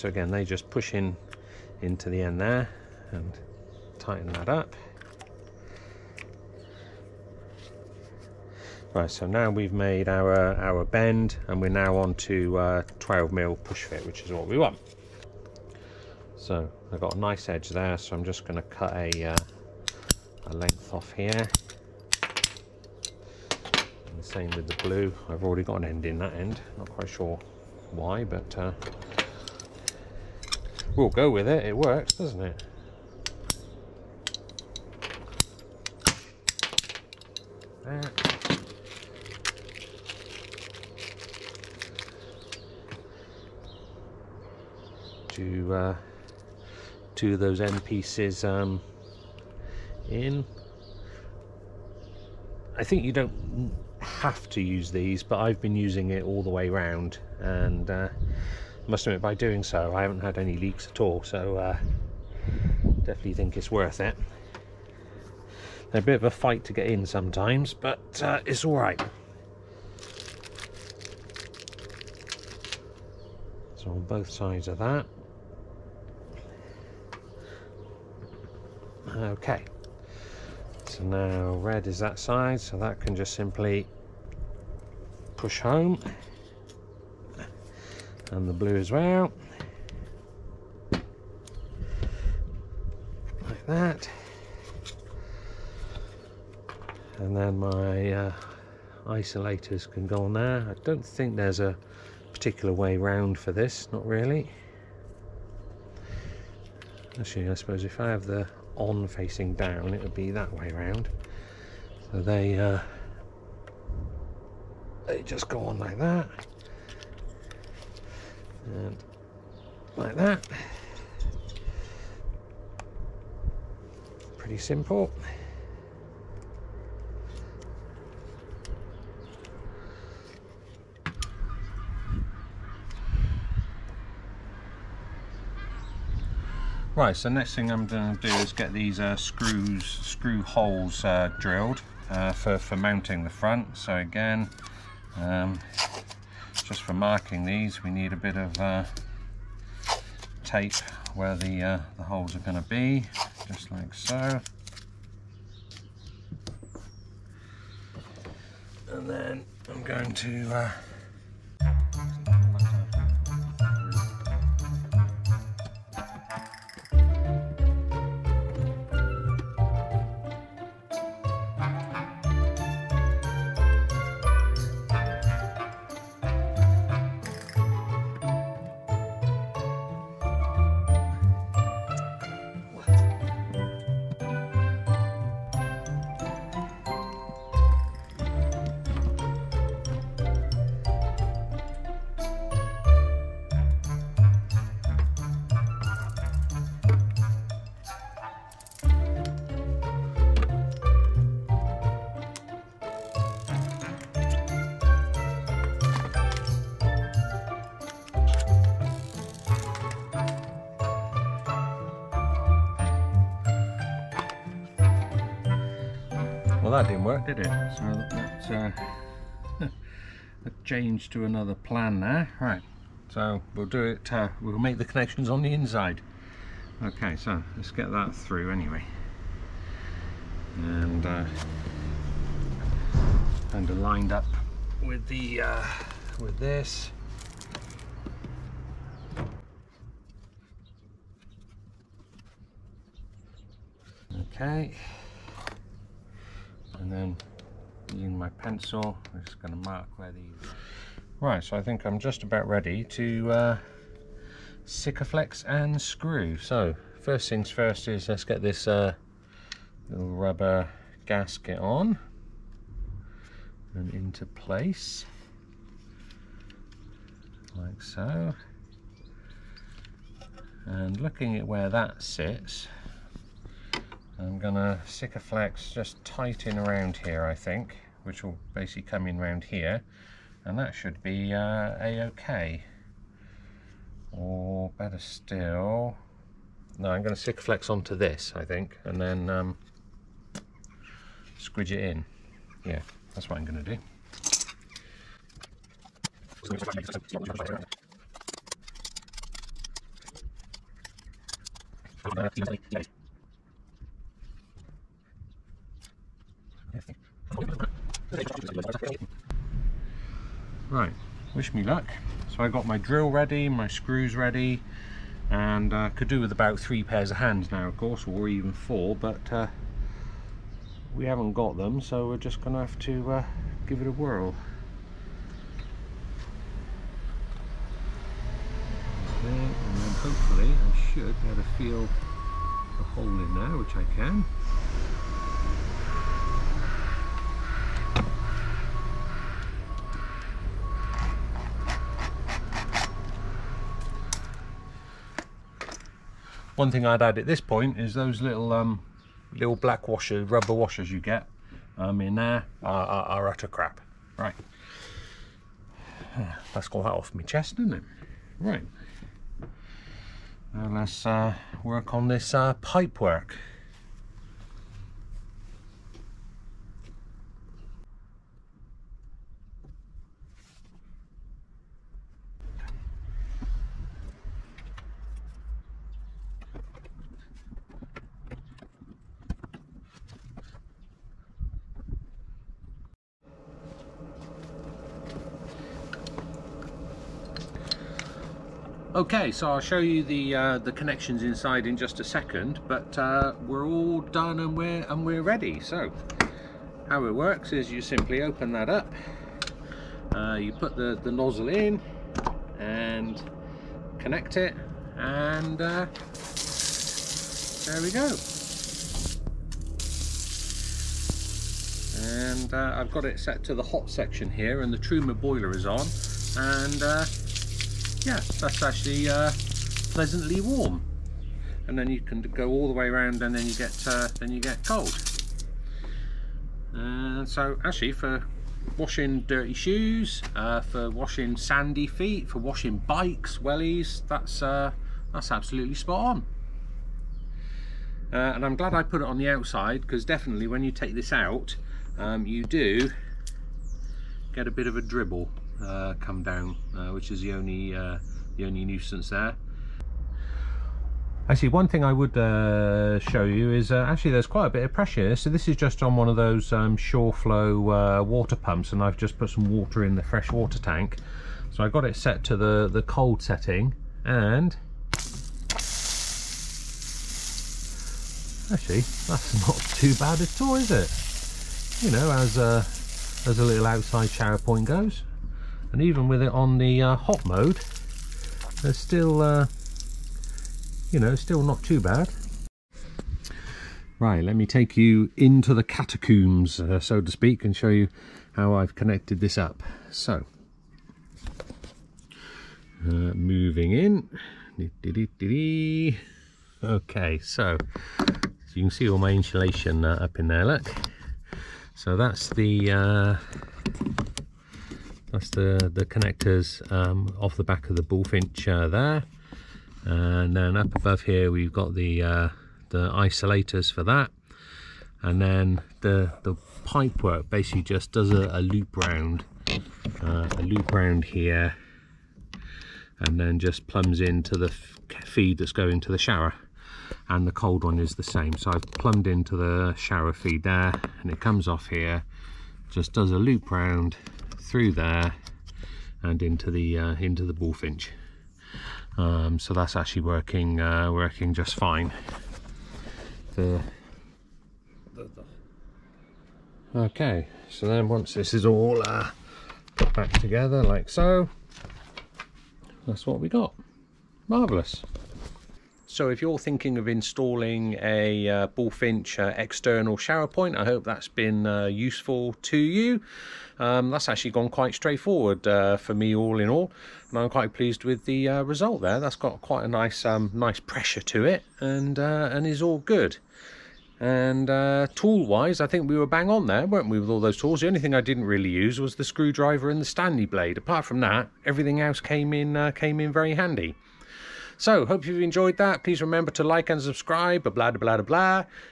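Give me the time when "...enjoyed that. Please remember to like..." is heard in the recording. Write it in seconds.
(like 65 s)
585 s.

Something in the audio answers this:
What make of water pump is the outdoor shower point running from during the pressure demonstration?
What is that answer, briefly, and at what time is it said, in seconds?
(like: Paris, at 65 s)
Shurflo, at 456 s.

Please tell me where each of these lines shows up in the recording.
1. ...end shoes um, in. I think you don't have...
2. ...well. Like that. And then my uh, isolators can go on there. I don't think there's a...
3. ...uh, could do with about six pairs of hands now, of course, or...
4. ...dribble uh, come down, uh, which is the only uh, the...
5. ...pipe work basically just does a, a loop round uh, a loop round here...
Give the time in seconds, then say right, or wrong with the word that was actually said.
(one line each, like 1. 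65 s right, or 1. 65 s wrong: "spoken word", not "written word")
1. 47 s wrong: "pieces", not "shoes"
2. 88 s right
3. 315 s wrong: "three", not "six"
4. 444 s right
5. 516 s right.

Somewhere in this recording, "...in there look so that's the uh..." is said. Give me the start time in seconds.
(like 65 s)
500 s.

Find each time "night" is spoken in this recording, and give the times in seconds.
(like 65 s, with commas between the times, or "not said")
not said.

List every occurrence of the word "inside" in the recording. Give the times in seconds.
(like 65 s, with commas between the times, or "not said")
225 s, 391 s.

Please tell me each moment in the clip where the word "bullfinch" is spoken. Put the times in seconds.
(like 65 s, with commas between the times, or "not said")
507 s, 537 s, 558 s.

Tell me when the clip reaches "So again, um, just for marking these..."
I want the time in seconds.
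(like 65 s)
143 s.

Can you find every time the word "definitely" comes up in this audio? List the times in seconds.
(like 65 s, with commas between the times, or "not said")
63 s, 440 s.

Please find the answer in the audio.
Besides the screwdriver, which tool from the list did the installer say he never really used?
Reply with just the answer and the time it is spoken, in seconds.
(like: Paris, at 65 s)
Stanley blade, at 579 s.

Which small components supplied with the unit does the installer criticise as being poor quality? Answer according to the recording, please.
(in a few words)
rubber washers.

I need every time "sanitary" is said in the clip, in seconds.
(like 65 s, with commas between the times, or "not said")
not said.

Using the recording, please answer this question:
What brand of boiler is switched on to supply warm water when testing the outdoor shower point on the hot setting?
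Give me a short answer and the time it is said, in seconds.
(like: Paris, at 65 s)
Truma, at 414 s.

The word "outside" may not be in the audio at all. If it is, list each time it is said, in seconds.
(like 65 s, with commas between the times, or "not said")
439 s, 473 s.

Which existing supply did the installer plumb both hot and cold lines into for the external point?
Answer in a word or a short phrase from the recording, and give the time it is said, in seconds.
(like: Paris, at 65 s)
the shower feed, at 529 s.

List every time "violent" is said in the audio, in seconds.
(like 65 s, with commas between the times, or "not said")
not said.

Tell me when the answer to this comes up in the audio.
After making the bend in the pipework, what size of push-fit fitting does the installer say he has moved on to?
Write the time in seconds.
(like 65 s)
12 s.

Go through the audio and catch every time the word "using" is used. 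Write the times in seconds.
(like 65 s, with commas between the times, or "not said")
55 s, 247 s.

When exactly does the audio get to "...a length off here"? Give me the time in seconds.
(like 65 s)
20 s.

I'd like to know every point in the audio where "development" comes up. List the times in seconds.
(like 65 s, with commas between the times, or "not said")
not said.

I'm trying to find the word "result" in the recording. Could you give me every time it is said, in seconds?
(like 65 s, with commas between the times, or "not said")
568 s.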